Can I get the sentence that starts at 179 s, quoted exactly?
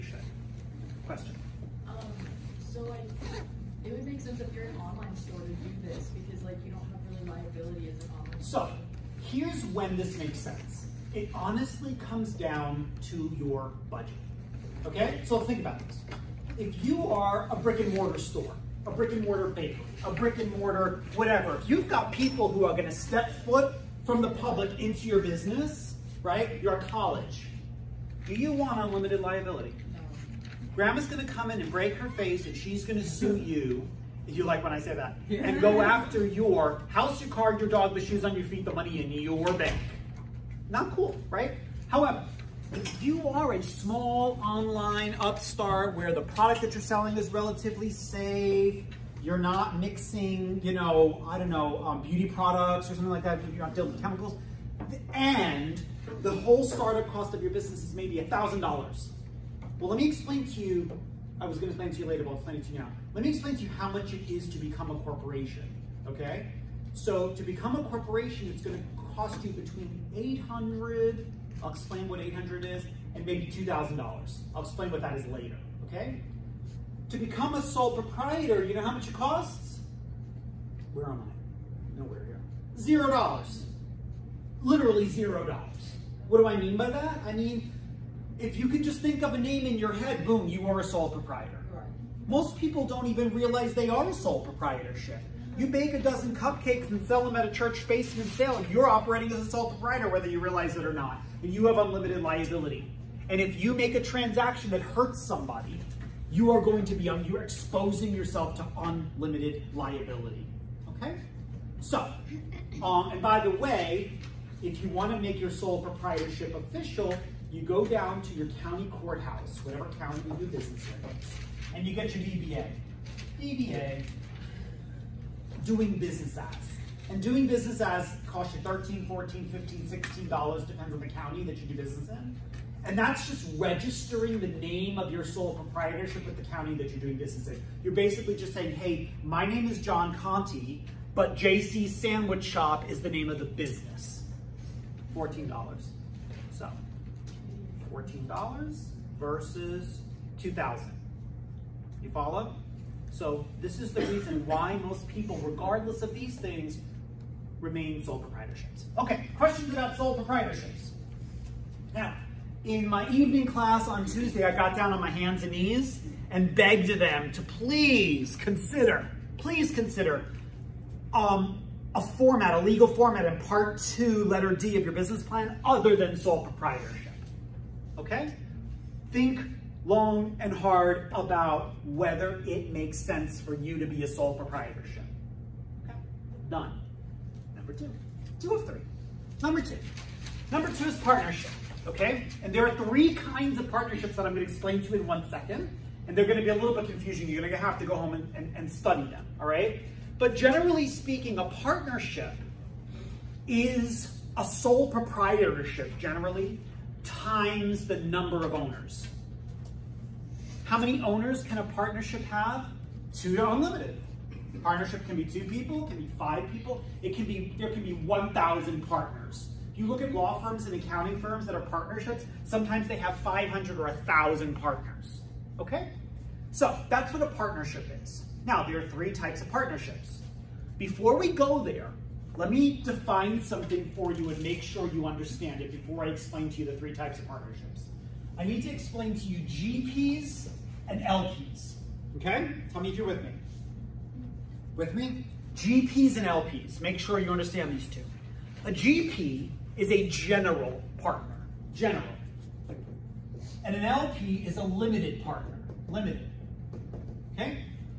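Think long and hard about whether it makes sense for you to be a sole proprietorship.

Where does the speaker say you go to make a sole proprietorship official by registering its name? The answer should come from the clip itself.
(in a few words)
county courthouse.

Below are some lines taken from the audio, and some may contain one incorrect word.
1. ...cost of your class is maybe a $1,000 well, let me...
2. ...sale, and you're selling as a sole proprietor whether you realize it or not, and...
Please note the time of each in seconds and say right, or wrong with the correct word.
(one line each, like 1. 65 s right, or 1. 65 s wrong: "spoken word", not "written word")
1. 57 s wrong: "business", not "class"
2. 98 s wrong: "operating", not "selling".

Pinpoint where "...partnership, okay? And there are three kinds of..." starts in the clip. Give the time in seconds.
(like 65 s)
190 s.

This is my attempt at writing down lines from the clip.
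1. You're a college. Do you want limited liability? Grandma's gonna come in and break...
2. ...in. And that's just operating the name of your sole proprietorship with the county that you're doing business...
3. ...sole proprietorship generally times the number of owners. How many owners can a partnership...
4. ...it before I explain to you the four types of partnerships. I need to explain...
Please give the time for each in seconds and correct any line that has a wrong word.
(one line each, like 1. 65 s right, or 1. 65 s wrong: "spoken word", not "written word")
1. 26 s wrong: "unlimited", not "limited"
2. 132 s wrong: "registering", not "operating"
3. 204 s right
4. 235 s wrong: "three", not "four".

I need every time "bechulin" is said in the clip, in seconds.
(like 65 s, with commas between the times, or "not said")
not said.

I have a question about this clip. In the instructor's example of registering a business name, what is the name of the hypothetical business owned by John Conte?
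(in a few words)
JC Sandwich Shop.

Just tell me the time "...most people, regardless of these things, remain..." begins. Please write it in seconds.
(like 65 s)
154 s.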